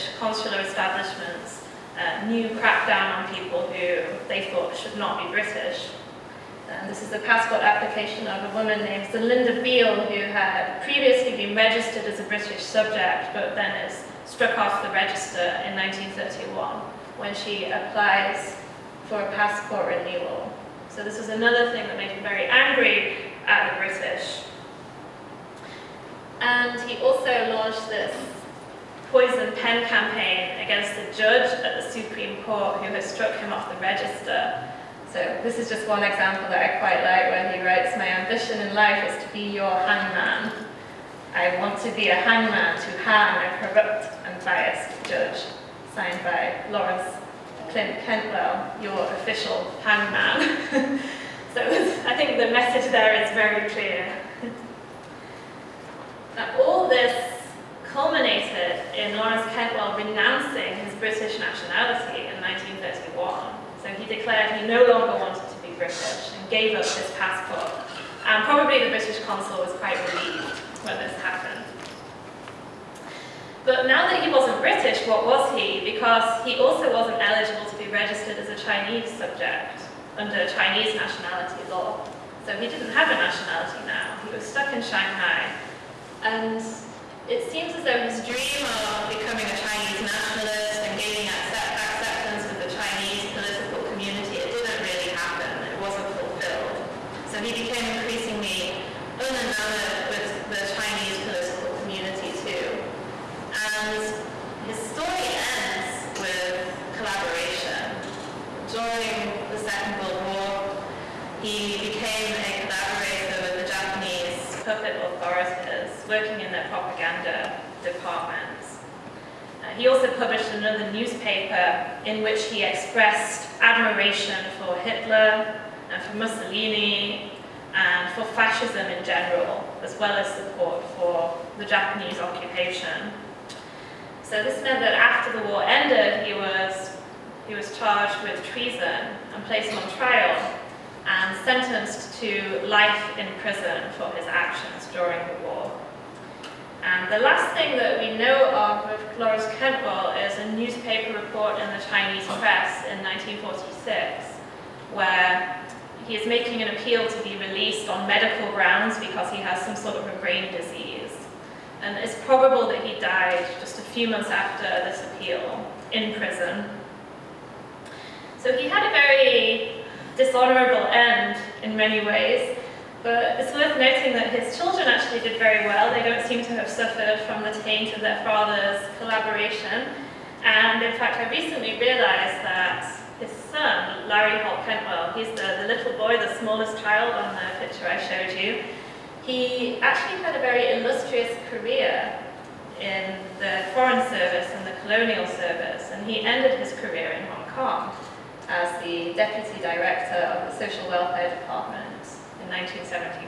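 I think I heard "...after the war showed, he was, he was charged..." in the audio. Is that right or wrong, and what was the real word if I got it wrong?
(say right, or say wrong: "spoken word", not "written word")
wrong: "ended", not "showed".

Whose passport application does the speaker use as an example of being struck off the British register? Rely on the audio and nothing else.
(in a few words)
Zelinda Beale.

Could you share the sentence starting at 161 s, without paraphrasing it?
And it's probable that he died just a few months after this appeal in prison.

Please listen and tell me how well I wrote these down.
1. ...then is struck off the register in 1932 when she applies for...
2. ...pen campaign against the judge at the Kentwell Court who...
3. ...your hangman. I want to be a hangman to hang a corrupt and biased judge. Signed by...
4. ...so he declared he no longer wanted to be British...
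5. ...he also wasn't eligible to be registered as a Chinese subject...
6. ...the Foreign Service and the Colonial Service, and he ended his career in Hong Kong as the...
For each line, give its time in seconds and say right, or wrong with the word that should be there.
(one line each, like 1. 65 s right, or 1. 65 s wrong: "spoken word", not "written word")
1. 13 s wrong: "1931", not "1932"
2. 29 s wrong: "Supreme", not "Kentwell"
3. 39 s right
4. 63 s right
5. 76 s right
6. 193 s right.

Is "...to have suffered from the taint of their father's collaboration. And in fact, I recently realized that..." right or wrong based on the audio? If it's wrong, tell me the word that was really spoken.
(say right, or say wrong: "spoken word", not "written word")
right.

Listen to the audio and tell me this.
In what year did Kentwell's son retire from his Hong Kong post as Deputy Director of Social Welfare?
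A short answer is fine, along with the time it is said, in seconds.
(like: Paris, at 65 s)
1971, at 202 s.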